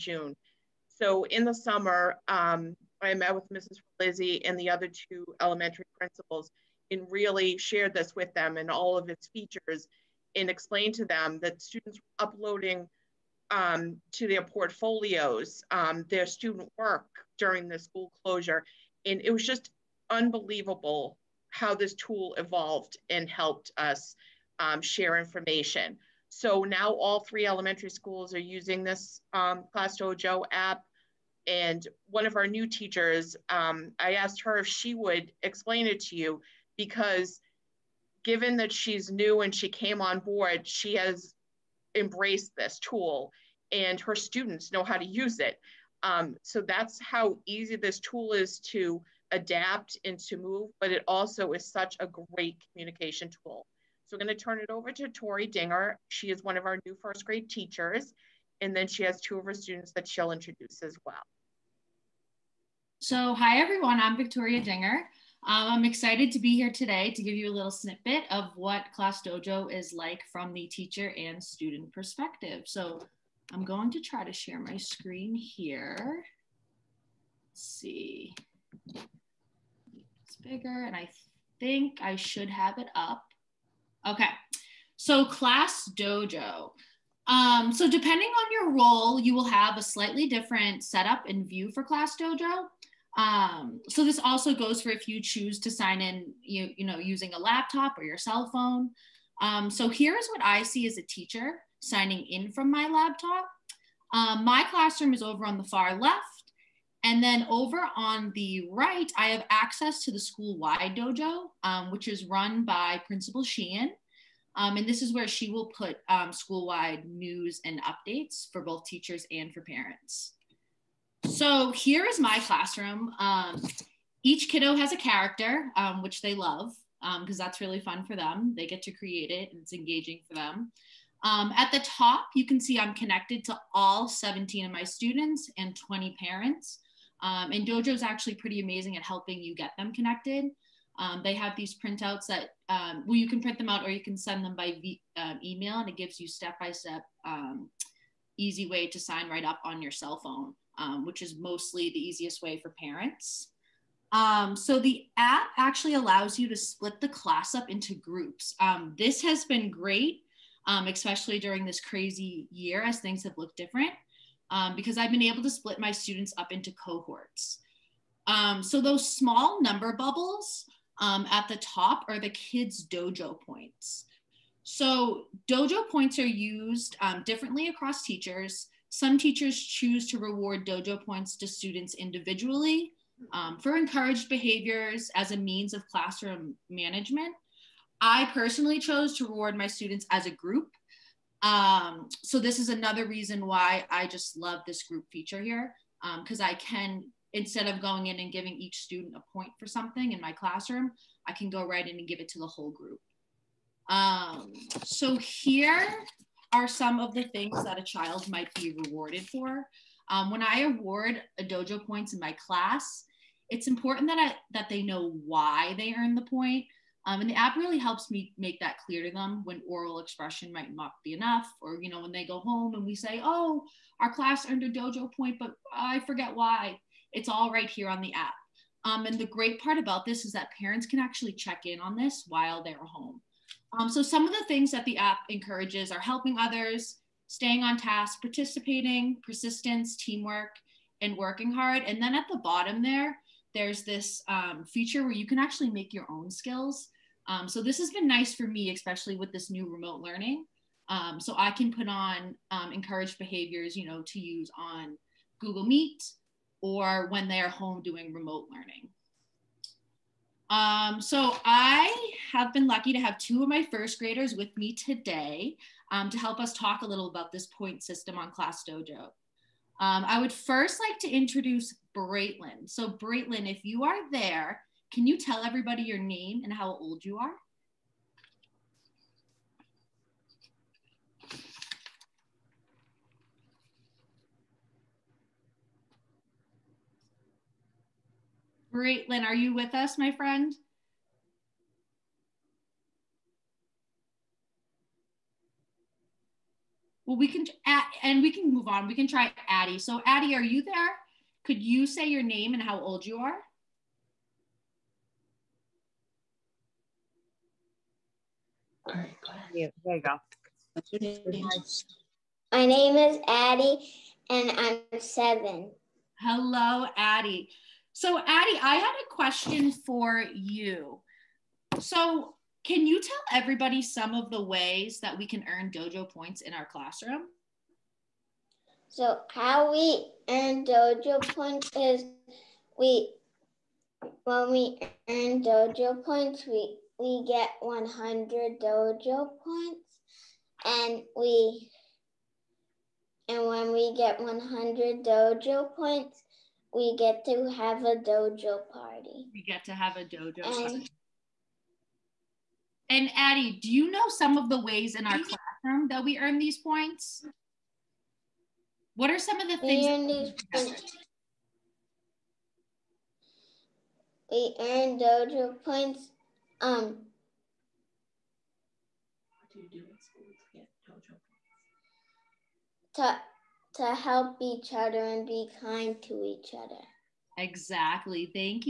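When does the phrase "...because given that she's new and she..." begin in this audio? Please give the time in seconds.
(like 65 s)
36 s.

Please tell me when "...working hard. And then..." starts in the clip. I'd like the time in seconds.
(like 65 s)
241 s.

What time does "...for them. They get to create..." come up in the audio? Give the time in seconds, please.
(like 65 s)
128 s.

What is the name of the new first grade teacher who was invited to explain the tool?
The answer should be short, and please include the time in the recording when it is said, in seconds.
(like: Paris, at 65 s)
Tori Dinger, at 55 s.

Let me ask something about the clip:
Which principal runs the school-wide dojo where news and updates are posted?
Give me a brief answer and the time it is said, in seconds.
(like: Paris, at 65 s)
Principal Sheehan, at 113 s.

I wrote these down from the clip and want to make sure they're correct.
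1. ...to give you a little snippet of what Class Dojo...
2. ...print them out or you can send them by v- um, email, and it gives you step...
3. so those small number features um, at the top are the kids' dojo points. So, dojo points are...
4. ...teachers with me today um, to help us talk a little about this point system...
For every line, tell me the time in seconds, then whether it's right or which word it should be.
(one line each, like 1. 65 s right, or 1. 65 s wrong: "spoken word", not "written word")
1. 67 s right
2. 143 s right
3. 168 s wrong: "bubbles", not "features"
4. 263 s wrong: "graders", not "teachers".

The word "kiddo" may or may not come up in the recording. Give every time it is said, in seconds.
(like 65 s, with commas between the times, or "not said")
124 s.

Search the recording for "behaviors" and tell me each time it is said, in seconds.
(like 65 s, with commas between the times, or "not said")
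184 s, 253 s.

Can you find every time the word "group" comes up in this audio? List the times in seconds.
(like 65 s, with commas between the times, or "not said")
157 s, 190 s, 194 s, 202 s.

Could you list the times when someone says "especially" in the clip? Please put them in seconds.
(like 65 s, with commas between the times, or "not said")
160 s, 248 s.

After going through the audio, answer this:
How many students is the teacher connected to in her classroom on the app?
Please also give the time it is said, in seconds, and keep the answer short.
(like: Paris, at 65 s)
17, at 134 s.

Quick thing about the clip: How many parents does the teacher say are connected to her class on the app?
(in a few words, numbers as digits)
20.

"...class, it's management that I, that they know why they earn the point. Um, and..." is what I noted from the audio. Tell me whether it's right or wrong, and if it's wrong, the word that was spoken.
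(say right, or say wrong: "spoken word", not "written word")
wrong: "important", not "management".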